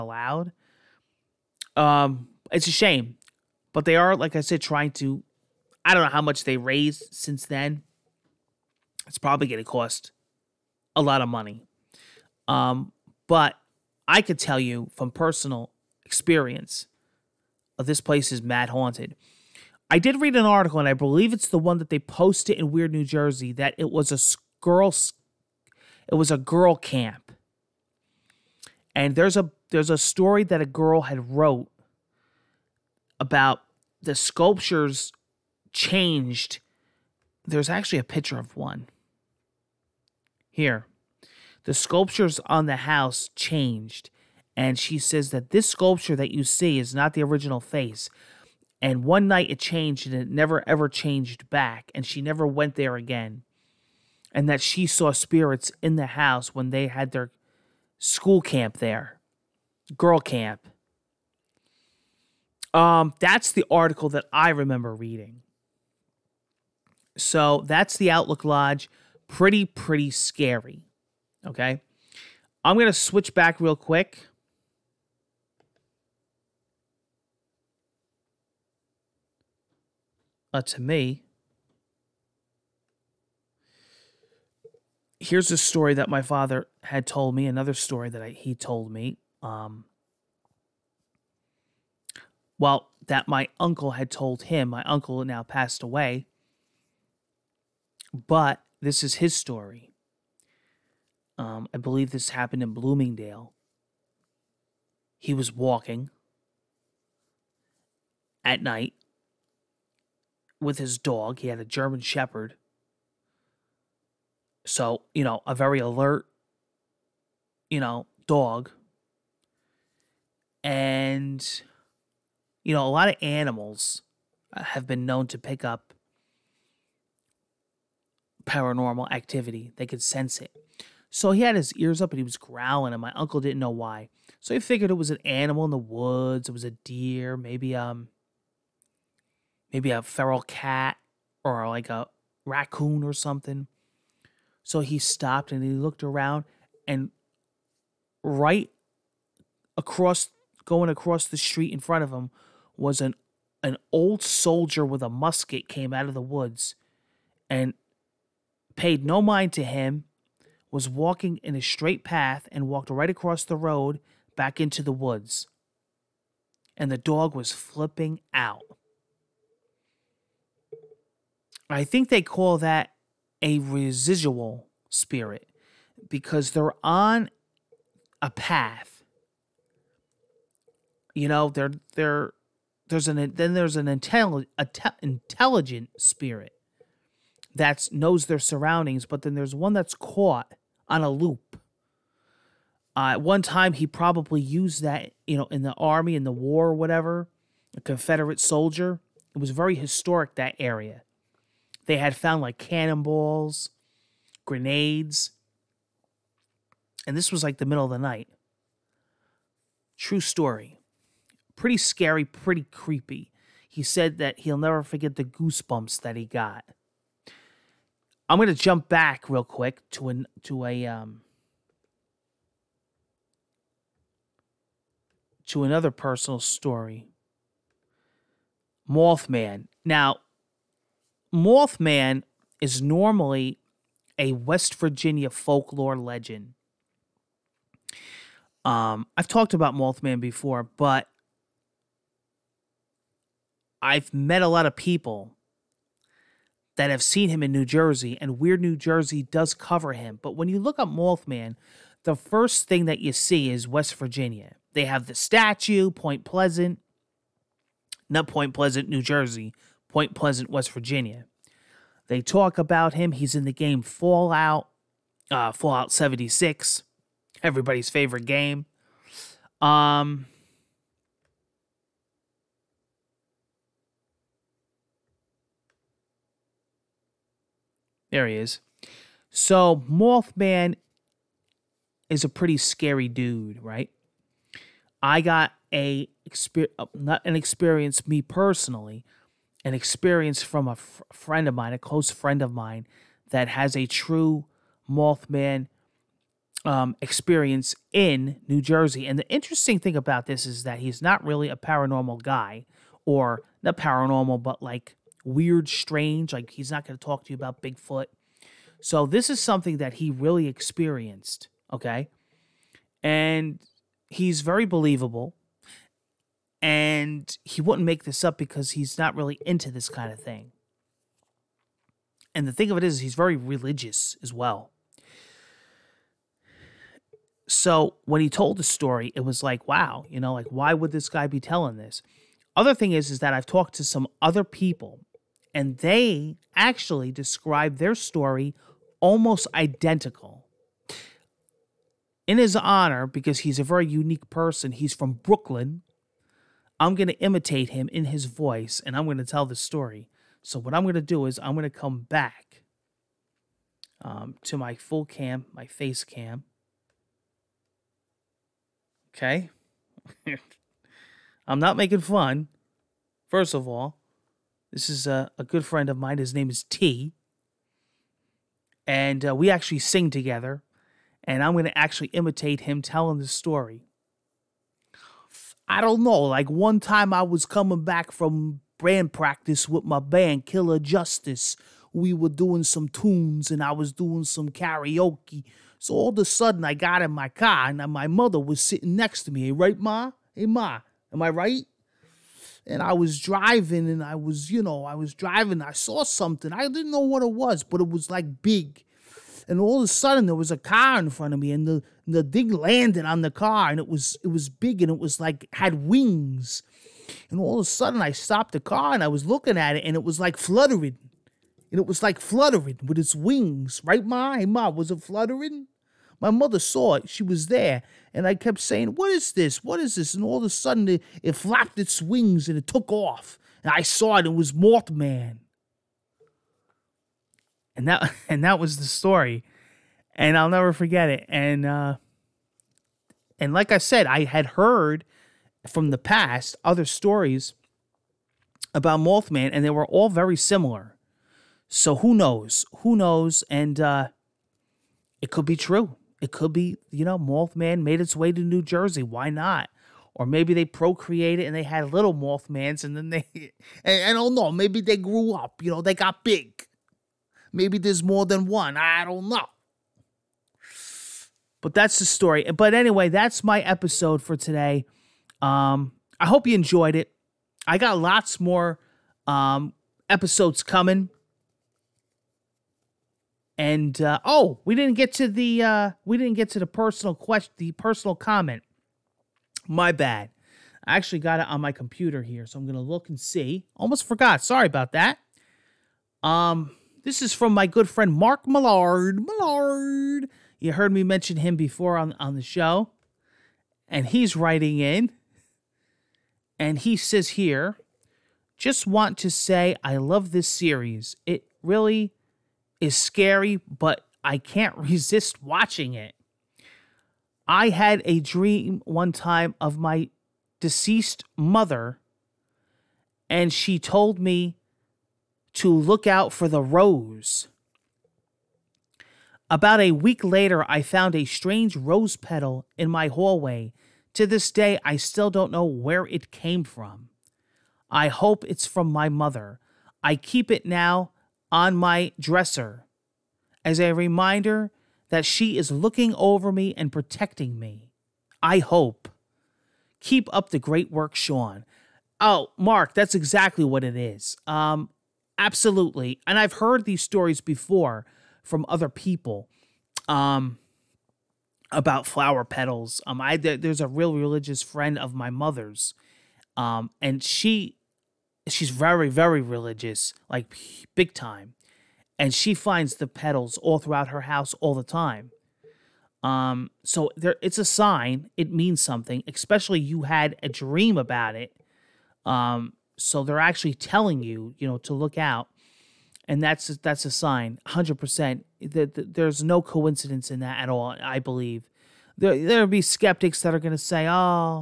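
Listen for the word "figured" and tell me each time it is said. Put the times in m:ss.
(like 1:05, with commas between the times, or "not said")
2:14.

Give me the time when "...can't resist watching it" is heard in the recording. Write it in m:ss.
8:24.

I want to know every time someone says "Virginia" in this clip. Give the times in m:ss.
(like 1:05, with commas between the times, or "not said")
3:54, 4:13, 4:20.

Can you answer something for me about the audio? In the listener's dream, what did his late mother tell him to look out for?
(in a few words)
the rose.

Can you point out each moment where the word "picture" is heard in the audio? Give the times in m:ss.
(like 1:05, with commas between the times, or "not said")
0:38.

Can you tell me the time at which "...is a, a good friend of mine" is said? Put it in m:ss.
6:04.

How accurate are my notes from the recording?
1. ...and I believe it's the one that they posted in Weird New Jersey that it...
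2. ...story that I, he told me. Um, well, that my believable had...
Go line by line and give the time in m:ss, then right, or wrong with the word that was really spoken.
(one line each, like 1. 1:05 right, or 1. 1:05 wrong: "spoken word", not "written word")
1. 0:20 right
2. 1:27 wrong: "uncle", not "believable".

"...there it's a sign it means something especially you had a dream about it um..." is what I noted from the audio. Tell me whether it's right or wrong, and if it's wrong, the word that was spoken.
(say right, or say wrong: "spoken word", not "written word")
right.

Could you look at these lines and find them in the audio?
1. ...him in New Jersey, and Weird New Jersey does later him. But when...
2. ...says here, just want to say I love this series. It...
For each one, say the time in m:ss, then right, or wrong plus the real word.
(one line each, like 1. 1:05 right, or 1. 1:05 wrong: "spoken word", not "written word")
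1. 4:07 wrong: "cover", not "later"
2. 8:16 right.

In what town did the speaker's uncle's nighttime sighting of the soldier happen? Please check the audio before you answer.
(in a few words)
Bloomingdale.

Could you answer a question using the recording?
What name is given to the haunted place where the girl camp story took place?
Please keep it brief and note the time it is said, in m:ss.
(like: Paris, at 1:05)
Outlook Lodge, at 1:08.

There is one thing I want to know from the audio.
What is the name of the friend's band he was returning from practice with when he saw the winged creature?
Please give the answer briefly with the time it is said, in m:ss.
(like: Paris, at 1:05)
Killer Justice, at 6:20.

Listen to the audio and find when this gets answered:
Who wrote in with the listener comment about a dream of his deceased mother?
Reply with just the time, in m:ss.
8:08.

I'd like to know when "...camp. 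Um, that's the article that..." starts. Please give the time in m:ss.
1:00.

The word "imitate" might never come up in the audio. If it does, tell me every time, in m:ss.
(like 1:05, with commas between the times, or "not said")
5:47, 6:12.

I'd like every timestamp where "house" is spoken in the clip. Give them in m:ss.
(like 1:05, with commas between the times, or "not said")
0:42, 0:56, 9:24.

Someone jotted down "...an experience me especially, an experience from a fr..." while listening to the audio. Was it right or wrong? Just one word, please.
wrong.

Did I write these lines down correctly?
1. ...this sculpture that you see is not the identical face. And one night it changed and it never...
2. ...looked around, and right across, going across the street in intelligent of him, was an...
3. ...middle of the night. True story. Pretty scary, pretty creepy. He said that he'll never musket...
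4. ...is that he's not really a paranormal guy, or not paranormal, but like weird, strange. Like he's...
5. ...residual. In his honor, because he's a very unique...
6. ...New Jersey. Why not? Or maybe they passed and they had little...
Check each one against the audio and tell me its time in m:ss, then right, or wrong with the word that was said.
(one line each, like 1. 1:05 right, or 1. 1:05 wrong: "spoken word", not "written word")
1. 0:45 wrong: "original", not "identical"
2. 2:25 wrong: "front", not "intelligent"
3. 3:27 wrong: "forget", not "musket"
4. 5:00 right
5. 5:39 wrong: "identical", not "residual"
6. 7:28 wrong: "procreated", not "passed".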